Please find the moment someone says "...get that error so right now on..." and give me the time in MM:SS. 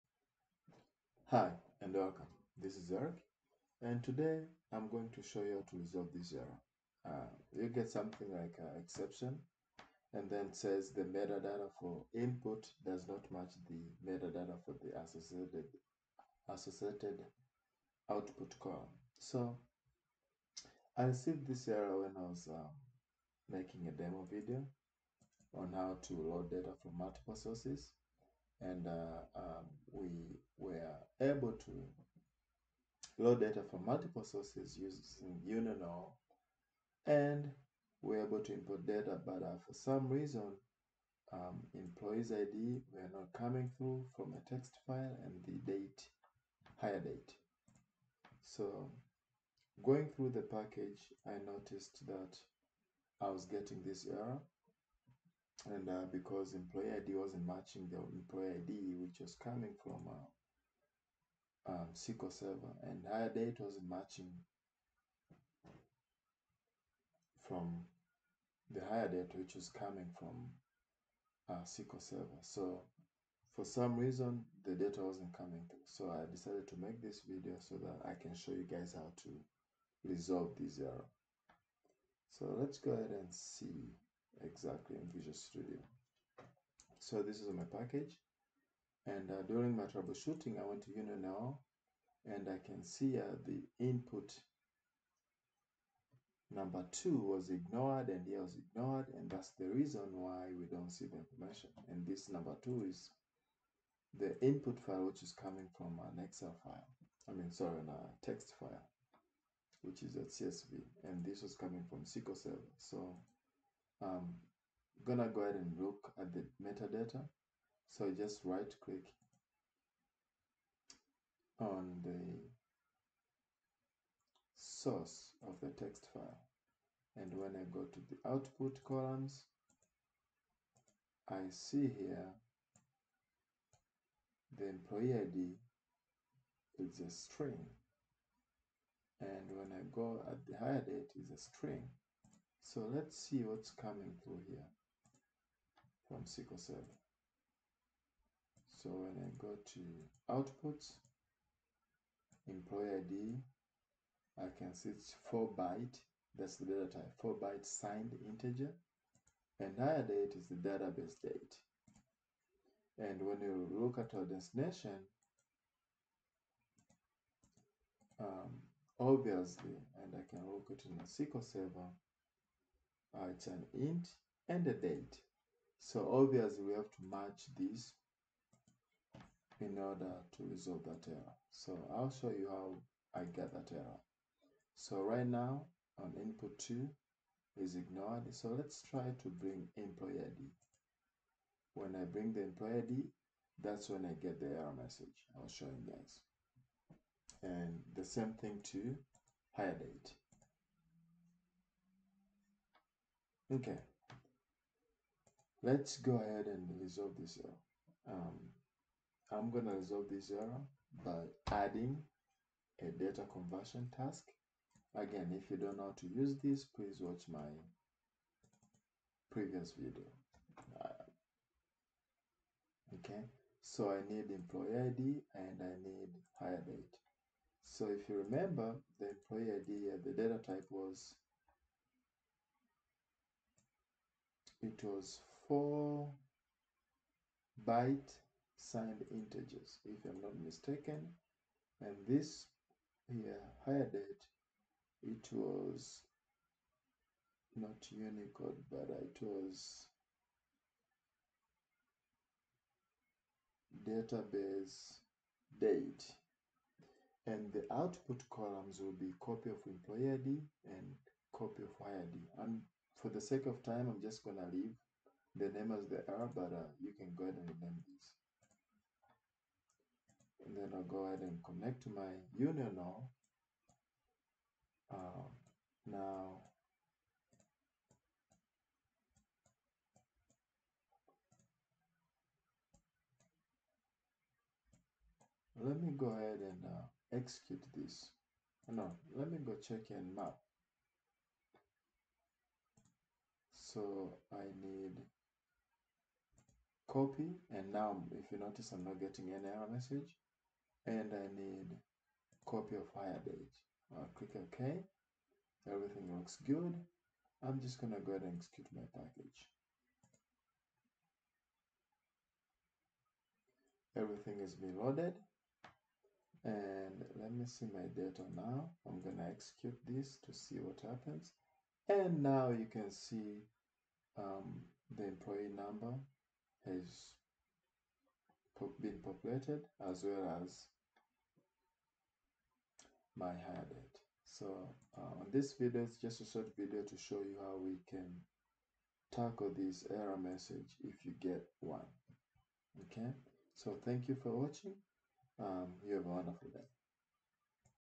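03:03.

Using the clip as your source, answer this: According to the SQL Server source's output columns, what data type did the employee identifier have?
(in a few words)
4 byte signed integer.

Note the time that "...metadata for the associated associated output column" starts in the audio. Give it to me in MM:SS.
00:14.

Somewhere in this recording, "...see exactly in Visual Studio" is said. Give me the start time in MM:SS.
01:23.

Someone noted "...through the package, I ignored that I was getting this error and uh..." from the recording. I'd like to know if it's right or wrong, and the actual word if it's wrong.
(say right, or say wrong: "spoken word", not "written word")
wrong: "noticed", not "ignored".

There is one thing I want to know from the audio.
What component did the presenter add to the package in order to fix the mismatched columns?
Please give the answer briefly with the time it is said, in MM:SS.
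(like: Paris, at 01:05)
data conversion task, at 03:32.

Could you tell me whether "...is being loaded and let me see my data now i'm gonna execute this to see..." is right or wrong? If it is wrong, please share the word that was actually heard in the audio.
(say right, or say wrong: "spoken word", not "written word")
right.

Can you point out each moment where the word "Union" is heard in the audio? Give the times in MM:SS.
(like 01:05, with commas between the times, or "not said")
00:35, 01:30, 04:32.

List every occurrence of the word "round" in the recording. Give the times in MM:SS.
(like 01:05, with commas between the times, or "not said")
not said.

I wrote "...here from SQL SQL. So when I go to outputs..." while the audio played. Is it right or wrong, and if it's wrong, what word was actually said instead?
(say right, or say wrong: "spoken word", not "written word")
wrong: "Server", not "SQL".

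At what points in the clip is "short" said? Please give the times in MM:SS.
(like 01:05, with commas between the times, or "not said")
05:36.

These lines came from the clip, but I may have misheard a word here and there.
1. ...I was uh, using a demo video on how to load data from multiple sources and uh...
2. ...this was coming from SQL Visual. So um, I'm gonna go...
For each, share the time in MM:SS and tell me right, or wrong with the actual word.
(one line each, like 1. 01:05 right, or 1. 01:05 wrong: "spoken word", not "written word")
1. 00:22 wrong: "making", not "using"
2. 01:51 wrong: "Server", not "Visual".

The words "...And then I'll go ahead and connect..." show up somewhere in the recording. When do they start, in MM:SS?
04:30.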